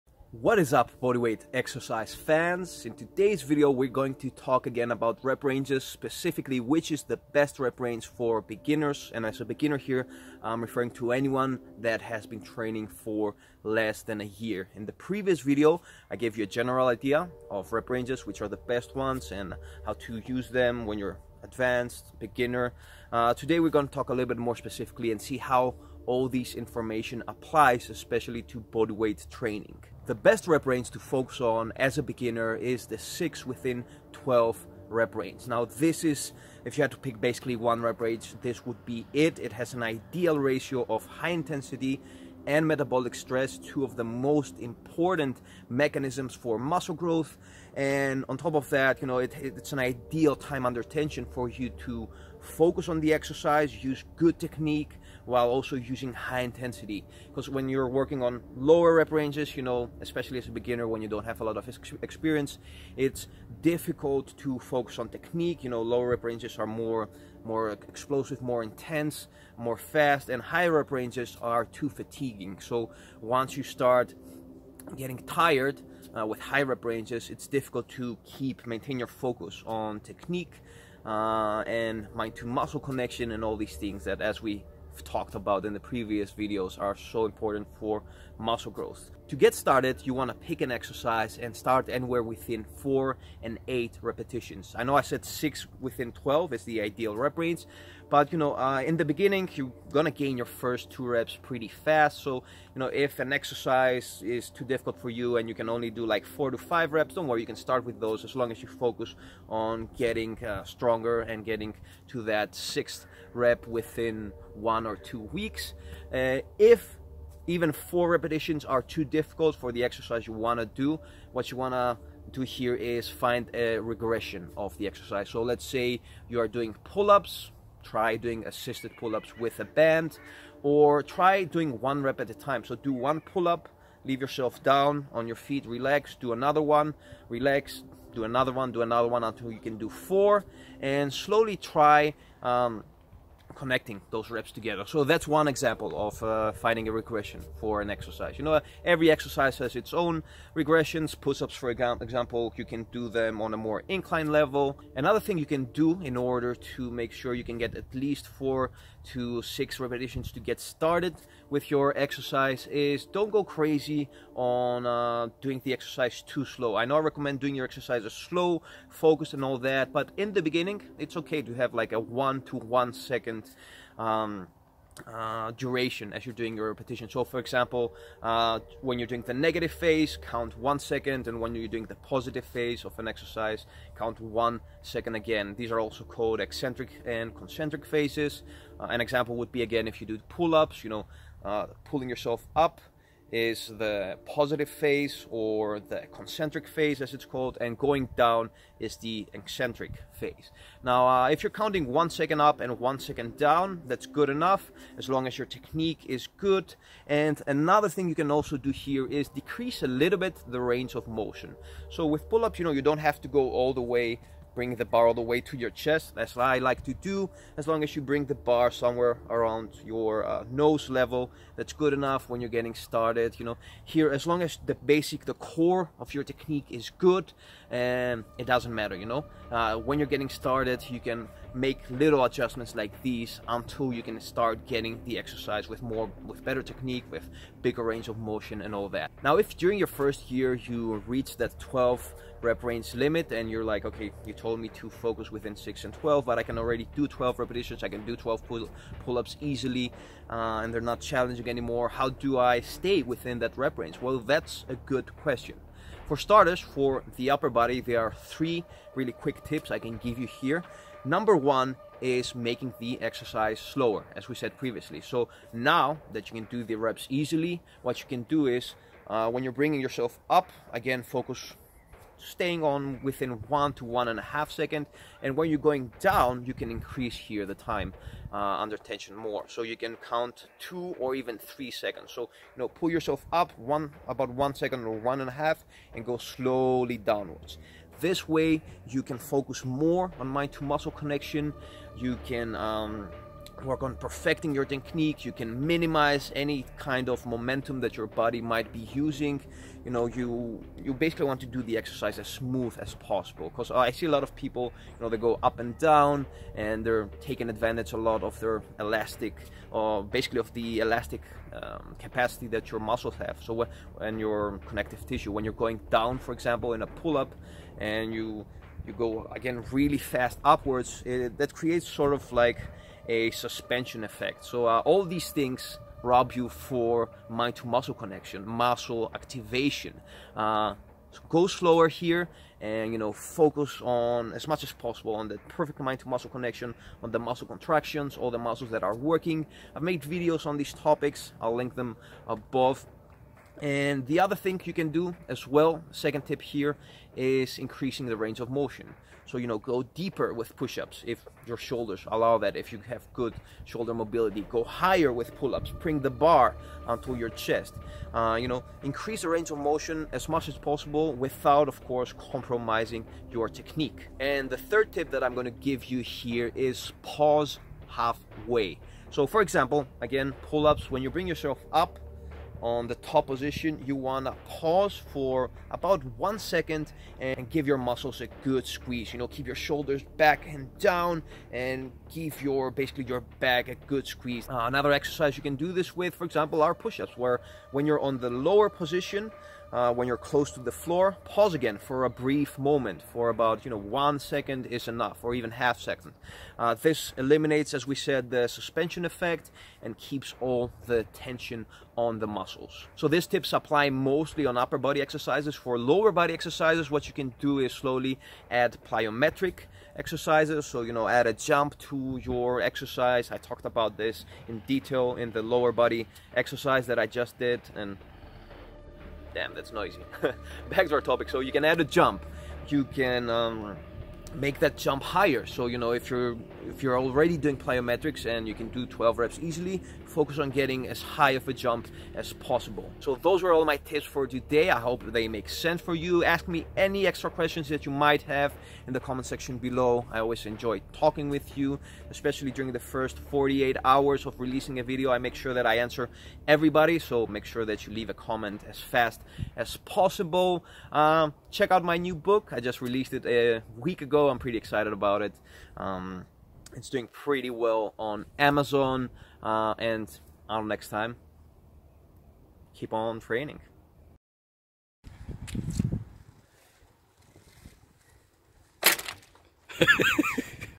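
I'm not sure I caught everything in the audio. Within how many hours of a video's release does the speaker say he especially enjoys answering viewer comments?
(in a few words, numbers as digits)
48.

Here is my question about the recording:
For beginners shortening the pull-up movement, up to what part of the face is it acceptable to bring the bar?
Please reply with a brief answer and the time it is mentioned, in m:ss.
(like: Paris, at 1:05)
nose level, at 3:40.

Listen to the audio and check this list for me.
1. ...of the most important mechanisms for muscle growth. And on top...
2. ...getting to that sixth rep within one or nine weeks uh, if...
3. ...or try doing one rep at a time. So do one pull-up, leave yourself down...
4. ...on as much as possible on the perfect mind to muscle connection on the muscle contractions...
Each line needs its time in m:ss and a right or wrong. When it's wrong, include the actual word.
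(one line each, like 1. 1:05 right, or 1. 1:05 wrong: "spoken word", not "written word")
1. 0:43 right
2. 1:51 wrong: "two", not "nine"
3. 2:10 right
4. 5:33 right.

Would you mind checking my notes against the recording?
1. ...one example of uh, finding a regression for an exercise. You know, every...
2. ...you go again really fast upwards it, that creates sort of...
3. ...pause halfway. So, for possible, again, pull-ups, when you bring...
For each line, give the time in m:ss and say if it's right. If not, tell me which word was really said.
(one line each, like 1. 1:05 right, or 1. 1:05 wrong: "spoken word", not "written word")
1. 2:25 right
2. 5:18 right
3. 6:07 wrong: "example", not "possible".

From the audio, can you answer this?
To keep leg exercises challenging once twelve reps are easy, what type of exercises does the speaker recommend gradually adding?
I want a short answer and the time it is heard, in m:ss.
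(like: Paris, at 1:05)
plyometric exercises, at 6:48.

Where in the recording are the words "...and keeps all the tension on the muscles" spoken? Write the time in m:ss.
6:39.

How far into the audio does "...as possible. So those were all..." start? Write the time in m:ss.
7:12.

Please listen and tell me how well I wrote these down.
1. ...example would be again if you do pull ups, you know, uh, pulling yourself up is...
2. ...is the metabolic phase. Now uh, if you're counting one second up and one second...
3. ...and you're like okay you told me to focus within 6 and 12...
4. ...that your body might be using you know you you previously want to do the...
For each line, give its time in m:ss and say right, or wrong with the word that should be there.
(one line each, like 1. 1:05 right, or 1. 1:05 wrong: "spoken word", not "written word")
1. 3:09 right
2. 3:18 wrong: "eccentric", not "metabolic"
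3. 4:03 right
4. 4:57 wrong: "basically", not "previously".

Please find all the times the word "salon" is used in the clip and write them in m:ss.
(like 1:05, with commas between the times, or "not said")
not said.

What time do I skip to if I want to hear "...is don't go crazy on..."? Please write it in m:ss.
2:42.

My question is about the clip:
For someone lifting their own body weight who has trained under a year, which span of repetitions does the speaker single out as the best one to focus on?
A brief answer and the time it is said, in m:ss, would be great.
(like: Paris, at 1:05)
6 to 12, at 0:32.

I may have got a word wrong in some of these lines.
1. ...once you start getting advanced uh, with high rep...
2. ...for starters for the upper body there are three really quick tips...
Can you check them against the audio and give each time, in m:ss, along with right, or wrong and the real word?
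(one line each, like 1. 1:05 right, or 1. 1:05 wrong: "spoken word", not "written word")
1. 1:13 wrong: "tired", not "advanced"
2. 4:16 right.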